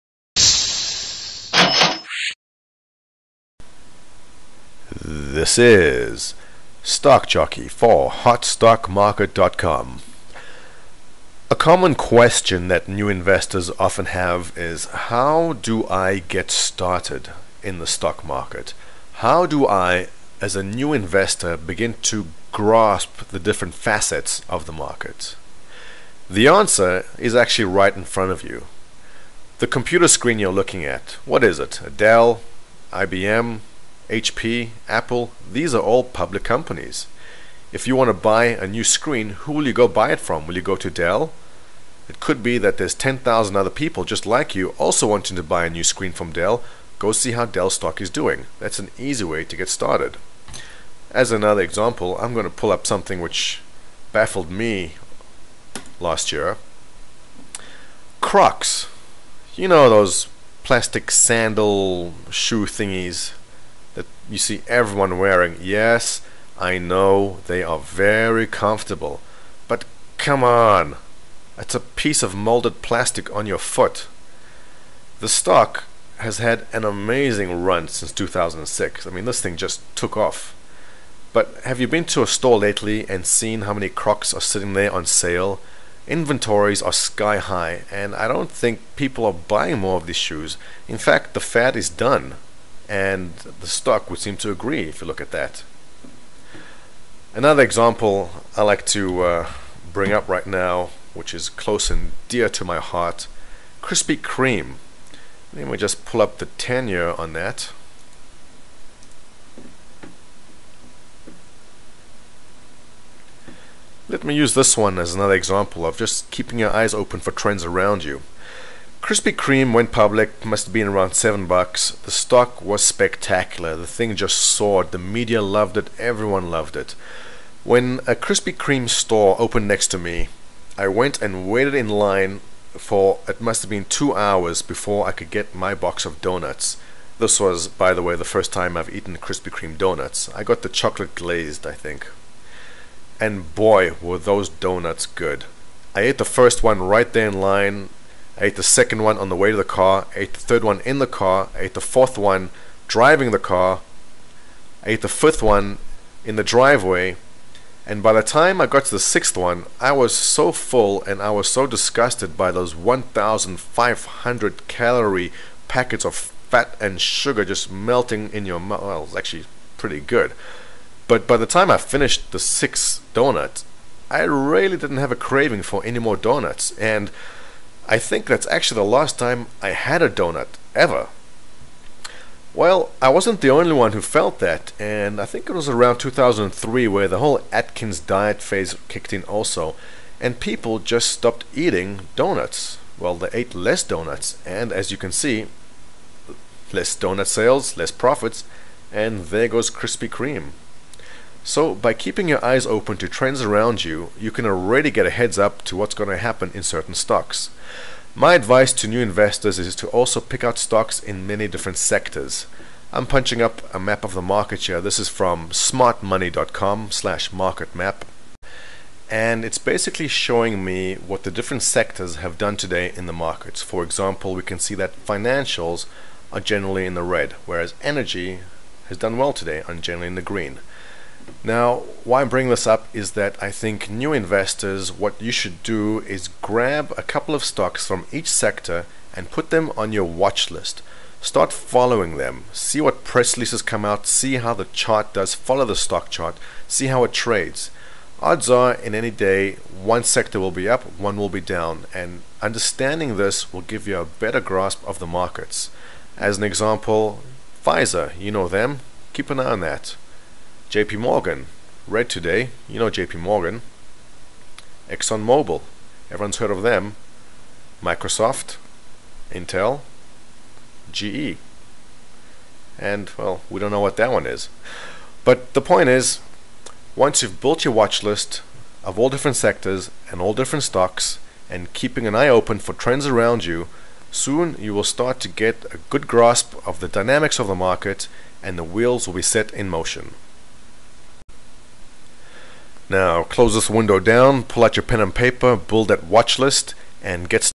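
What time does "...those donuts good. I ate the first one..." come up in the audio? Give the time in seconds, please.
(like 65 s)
144 s.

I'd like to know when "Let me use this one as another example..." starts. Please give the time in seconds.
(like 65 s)
114 s.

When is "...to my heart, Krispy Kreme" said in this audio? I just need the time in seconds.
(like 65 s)
102 s.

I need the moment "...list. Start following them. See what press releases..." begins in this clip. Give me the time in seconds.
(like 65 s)
240 s.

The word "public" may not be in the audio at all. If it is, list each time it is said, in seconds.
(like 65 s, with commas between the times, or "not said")
36 s, 119 s.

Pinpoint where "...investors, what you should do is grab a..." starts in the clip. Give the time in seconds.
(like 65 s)
234 s.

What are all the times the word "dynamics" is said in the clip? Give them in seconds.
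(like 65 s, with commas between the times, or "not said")
286 s.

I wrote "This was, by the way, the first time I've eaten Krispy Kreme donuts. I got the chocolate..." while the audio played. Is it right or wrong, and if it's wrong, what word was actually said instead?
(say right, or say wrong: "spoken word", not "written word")
right.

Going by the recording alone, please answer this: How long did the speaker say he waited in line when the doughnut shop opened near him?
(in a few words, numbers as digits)
2 hours.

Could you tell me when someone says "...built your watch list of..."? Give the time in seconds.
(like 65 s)
277 s.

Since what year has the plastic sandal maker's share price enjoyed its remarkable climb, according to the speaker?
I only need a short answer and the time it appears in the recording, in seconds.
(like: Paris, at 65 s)
2006, at 78 s.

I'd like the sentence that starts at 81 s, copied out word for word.
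But have you been to a store lately and seen how many Crocs are sitting there on sale?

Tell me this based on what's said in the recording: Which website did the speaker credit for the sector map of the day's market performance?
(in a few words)
smartmoney.com.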